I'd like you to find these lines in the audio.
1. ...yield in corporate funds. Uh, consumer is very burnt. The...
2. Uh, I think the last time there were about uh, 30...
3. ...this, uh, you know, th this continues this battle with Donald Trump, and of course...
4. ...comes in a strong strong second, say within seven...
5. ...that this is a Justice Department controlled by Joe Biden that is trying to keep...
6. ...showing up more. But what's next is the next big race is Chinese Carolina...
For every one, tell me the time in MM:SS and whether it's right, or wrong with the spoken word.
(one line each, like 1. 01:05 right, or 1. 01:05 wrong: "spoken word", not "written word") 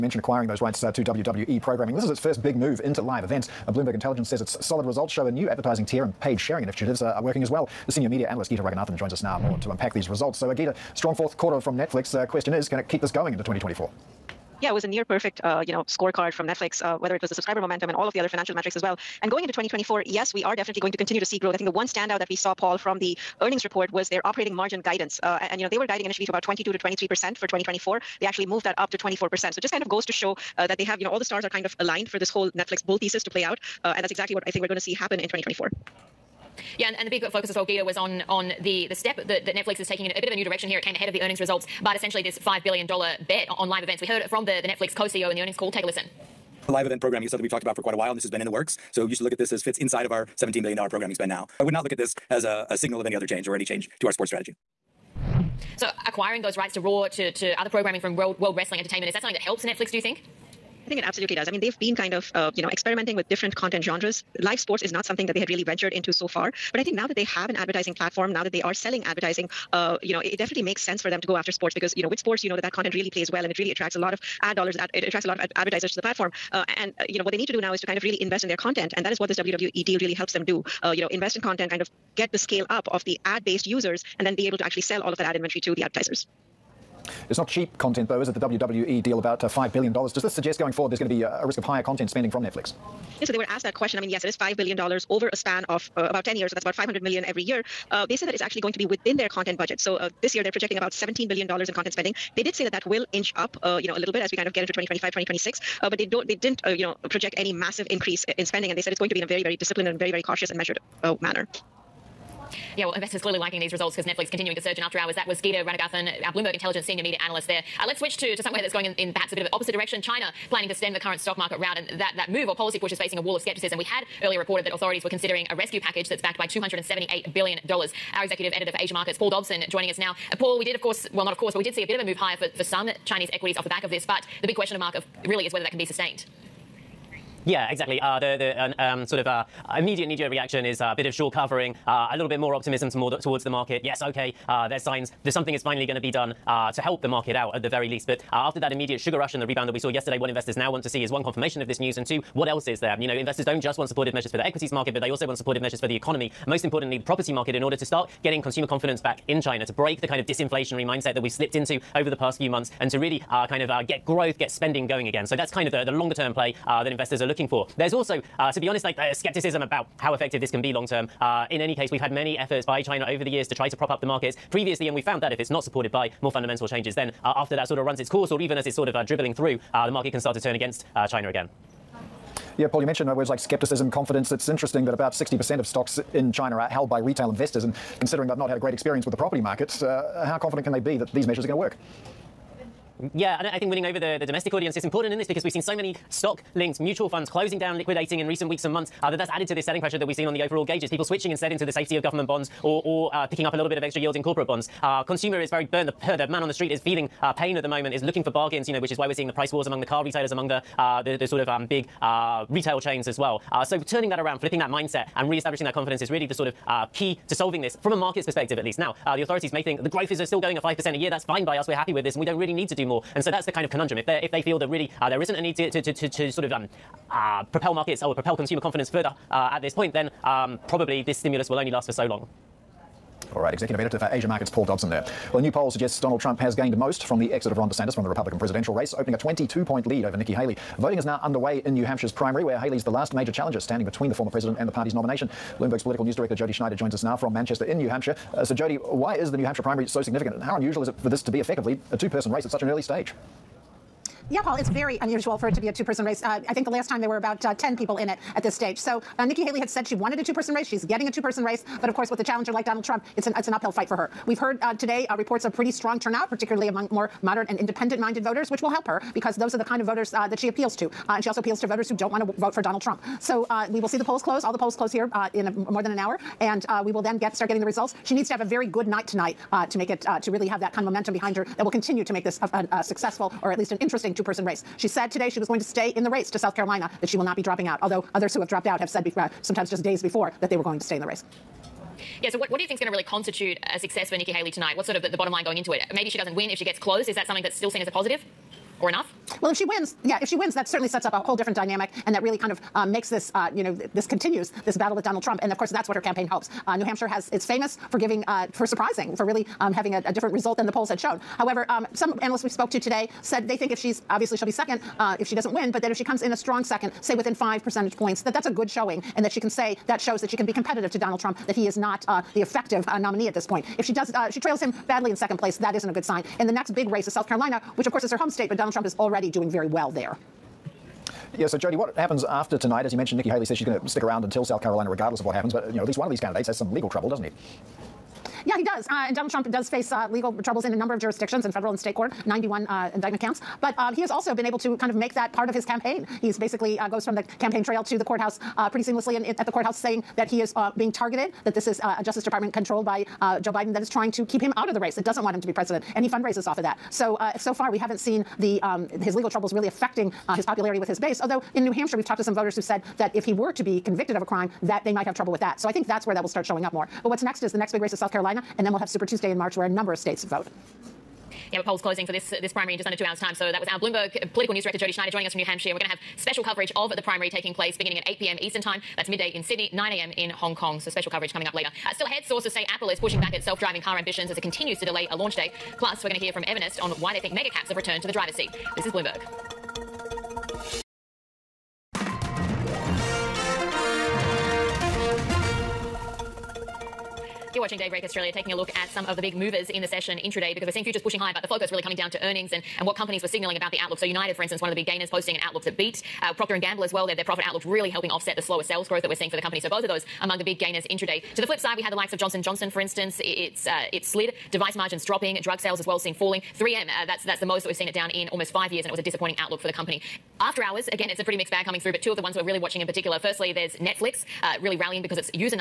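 1. 03:23 wrong: "bonds", not "funds"
2. 04:16 wrong: "10", not "30"
3. 05:03 right
4. 05:16 wrong: "five", not "seven"
5. 05:51 right
6. 06:06 wrong: "South", not "Chinese".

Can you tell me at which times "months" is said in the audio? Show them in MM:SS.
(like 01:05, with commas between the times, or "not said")
02:42, 03:18.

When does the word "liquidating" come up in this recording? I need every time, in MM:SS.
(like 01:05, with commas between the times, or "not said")
03:17.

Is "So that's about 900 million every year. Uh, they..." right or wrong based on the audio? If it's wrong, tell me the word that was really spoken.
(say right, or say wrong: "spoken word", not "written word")
wrong: "500", not "900".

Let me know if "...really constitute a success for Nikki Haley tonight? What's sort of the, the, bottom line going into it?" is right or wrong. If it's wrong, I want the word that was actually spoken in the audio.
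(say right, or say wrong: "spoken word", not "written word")
right.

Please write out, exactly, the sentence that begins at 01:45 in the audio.
Uh, but they don't, they didn't, uh, you know, project any massive increase in spending.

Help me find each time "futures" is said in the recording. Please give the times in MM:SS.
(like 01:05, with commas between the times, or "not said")
06:40.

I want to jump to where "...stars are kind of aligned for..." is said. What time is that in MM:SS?
00:31.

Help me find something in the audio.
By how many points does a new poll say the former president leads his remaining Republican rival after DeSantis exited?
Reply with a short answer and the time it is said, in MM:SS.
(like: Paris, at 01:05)
22 points, at 03:59.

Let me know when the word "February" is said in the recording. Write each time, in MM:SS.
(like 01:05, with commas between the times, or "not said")
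not said.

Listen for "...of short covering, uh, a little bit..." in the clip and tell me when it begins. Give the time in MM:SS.
02:21.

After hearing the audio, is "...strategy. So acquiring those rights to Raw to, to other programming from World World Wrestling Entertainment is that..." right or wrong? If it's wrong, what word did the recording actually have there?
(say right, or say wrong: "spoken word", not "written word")
right.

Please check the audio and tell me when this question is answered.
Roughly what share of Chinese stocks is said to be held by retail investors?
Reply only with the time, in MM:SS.
03:05.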